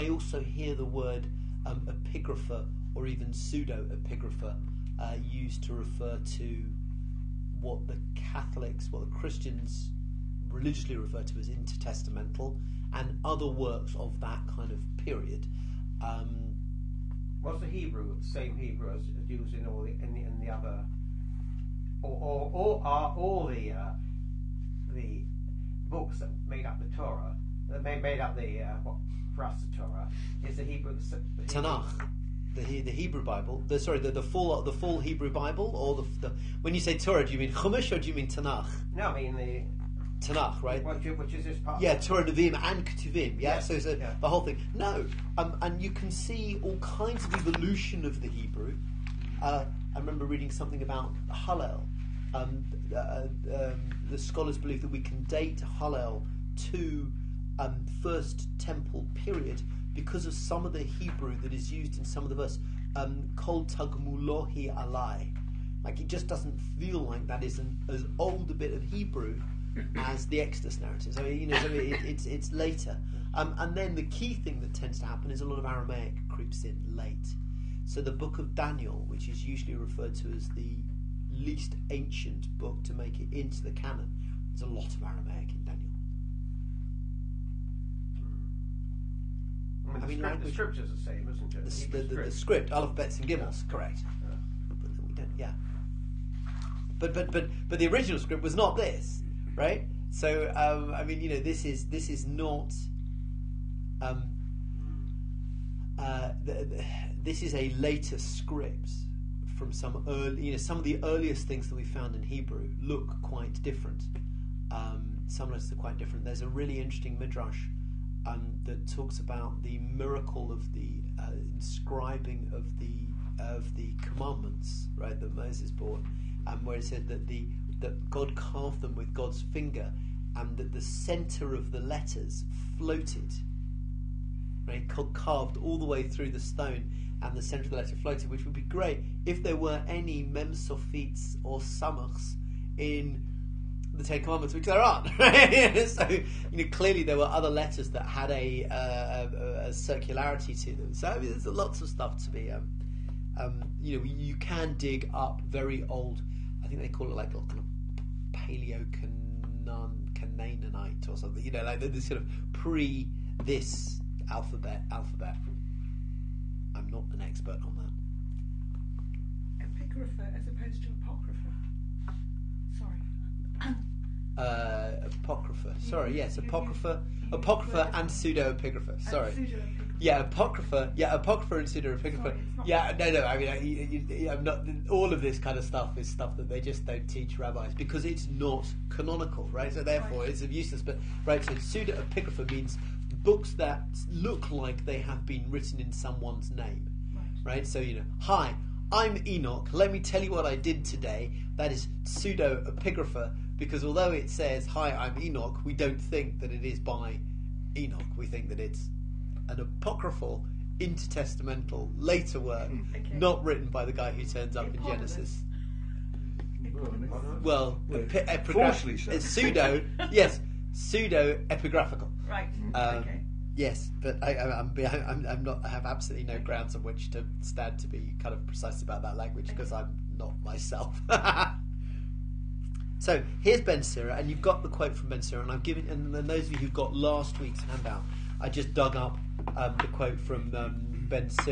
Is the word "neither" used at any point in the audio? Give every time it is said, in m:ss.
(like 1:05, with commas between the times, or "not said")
not said.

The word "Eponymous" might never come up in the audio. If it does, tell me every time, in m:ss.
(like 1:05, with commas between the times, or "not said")
3:34.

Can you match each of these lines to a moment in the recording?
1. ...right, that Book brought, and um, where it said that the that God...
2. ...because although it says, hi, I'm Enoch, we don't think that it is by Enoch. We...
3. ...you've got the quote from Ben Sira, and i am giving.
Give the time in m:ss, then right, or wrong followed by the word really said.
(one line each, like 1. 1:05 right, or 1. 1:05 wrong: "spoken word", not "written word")
1. 2:04 wrong: "Moses", not "Book"
2. 3:23 right
3. 3:54 right.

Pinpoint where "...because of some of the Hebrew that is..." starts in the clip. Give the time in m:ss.
0:59.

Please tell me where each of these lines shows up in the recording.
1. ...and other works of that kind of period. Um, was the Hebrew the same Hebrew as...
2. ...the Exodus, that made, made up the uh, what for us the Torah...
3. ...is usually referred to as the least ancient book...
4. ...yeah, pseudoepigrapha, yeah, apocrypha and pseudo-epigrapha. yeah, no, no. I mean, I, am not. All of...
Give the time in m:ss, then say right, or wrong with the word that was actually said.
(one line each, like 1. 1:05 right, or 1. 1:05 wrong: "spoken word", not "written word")
1. 0:12 right
2. 0:26 wrong: "Torah", not "Exodus"
3. 1:19 right
4. 3:00 wrong: "apocrypha", not "pseudoepigrapha".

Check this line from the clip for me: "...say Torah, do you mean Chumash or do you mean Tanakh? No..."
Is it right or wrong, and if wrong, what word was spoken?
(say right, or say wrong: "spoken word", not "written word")
right.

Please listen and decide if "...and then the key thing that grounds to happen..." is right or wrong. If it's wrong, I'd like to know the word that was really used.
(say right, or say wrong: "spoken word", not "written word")
wrong: "tends", not "grounds".